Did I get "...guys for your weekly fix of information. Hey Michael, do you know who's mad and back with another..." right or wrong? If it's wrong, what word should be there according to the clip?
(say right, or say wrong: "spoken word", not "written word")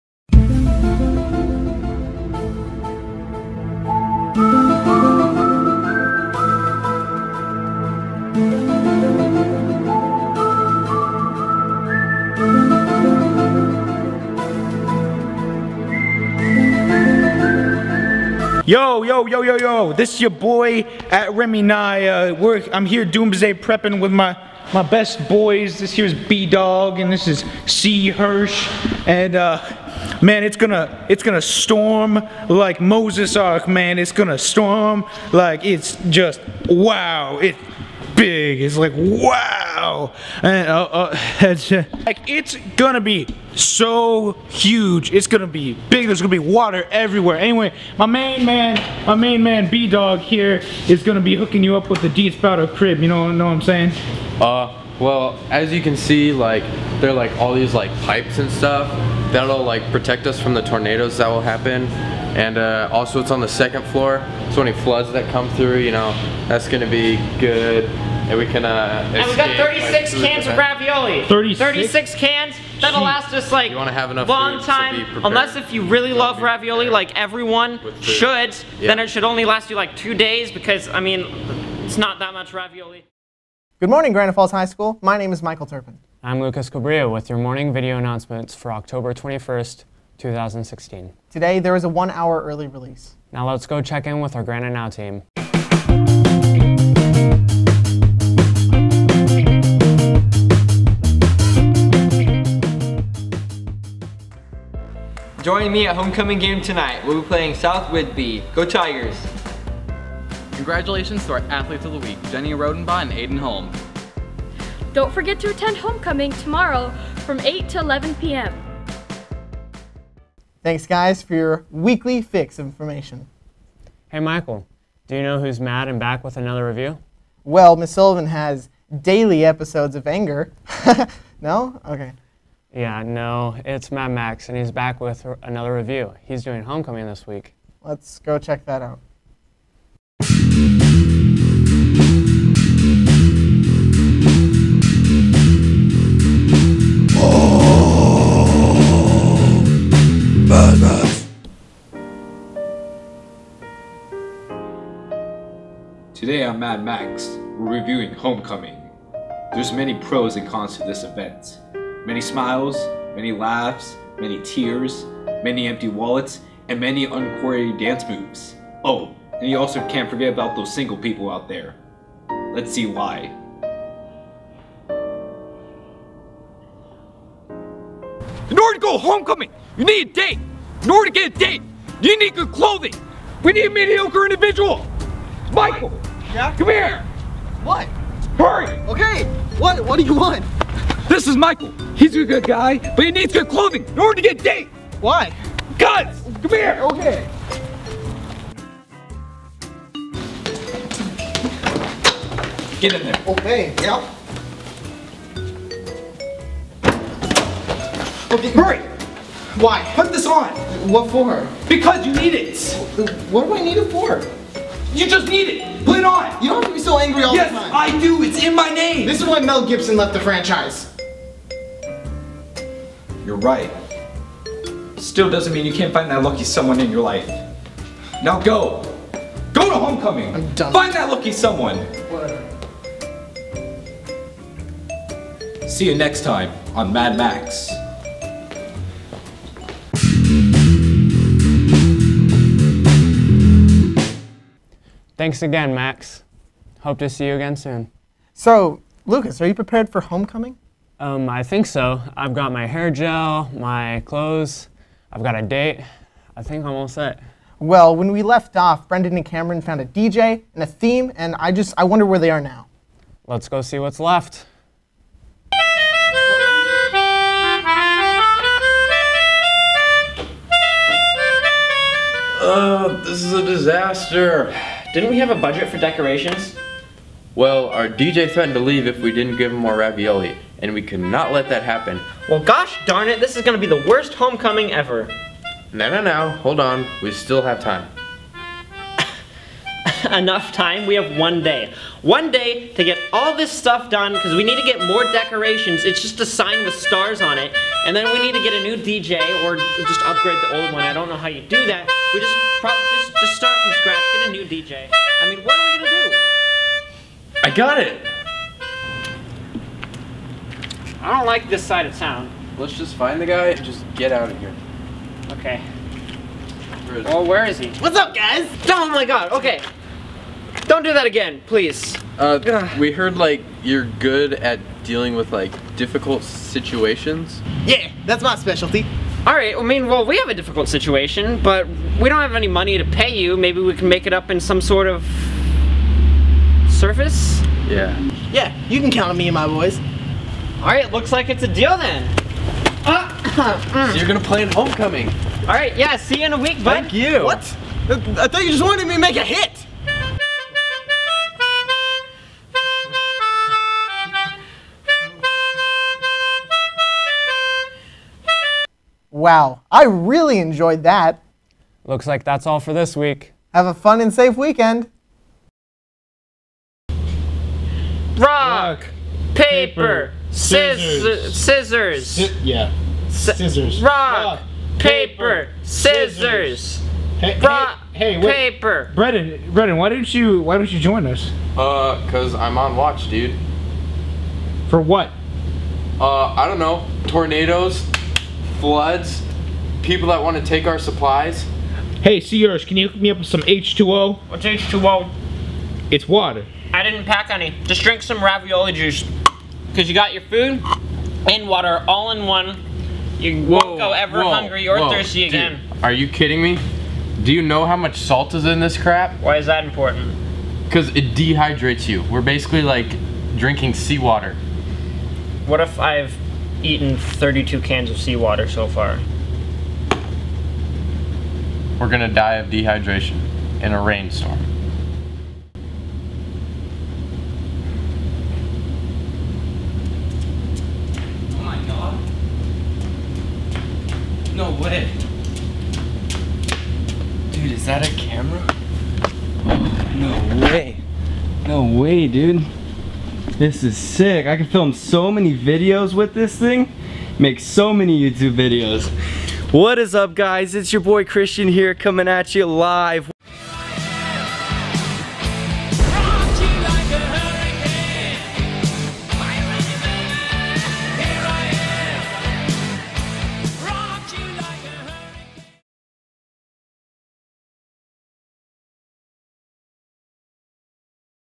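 right.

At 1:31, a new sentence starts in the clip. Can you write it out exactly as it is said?
Today, there is a one hour early release.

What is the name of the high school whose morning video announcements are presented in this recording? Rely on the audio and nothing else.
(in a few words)
Granite Falls High School.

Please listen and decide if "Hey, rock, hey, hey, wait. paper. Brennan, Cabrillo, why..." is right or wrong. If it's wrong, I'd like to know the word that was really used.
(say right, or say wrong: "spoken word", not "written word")
wrong: "Brennan", not "Cabrillo".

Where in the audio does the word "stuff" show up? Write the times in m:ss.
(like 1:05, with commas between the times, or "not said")
0:58, 4:53.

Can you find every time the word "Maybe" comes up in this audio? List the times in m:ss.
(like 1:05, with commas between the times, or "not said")
5:33.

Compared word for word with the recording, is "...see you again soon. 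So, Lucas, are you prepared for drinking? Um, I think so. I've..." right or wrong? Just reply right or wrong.
wrong.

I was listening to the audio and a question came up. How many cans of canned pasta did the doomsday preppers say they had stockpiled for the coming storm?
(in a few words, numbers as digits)
36.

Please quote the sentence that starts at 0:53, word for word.
You know, know what I'm saying?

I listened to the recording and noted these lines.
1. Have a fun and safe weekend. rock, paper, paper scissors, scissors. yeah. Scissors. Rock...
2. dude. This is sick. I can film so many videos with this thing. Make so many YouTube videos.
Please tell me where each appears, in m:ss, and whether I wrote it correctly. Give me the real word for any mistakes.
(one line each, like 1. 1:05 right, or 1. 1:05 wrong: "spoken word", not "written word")
1. 6:03 right
2. 7:22 right.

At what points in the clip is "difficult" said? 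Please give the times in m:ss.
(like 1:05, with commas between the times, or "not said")
5:25, 5:30.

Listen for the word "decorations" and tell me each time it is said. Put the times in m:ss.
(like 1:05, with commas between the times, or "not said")
4:35, 4:55.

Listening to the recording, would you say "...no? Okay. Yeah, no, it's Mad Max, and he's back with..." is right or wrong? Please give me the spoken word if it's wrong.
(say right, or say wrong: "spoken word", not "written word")
right.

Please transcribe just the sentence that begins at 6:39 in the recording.
Because you got your food and water all in one.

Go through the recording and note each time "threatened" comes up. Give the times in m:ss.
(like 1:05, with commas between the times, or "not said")
4:38.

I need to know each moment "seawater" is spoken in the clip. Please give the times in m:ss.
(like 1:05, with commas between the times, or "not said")
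6:53, 6:57.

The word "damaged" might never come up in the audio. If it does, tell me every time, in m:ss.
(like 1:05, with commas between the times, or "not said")
not said.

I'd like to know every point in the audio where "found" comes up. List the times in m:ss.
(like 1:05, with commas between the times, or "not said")
4:19.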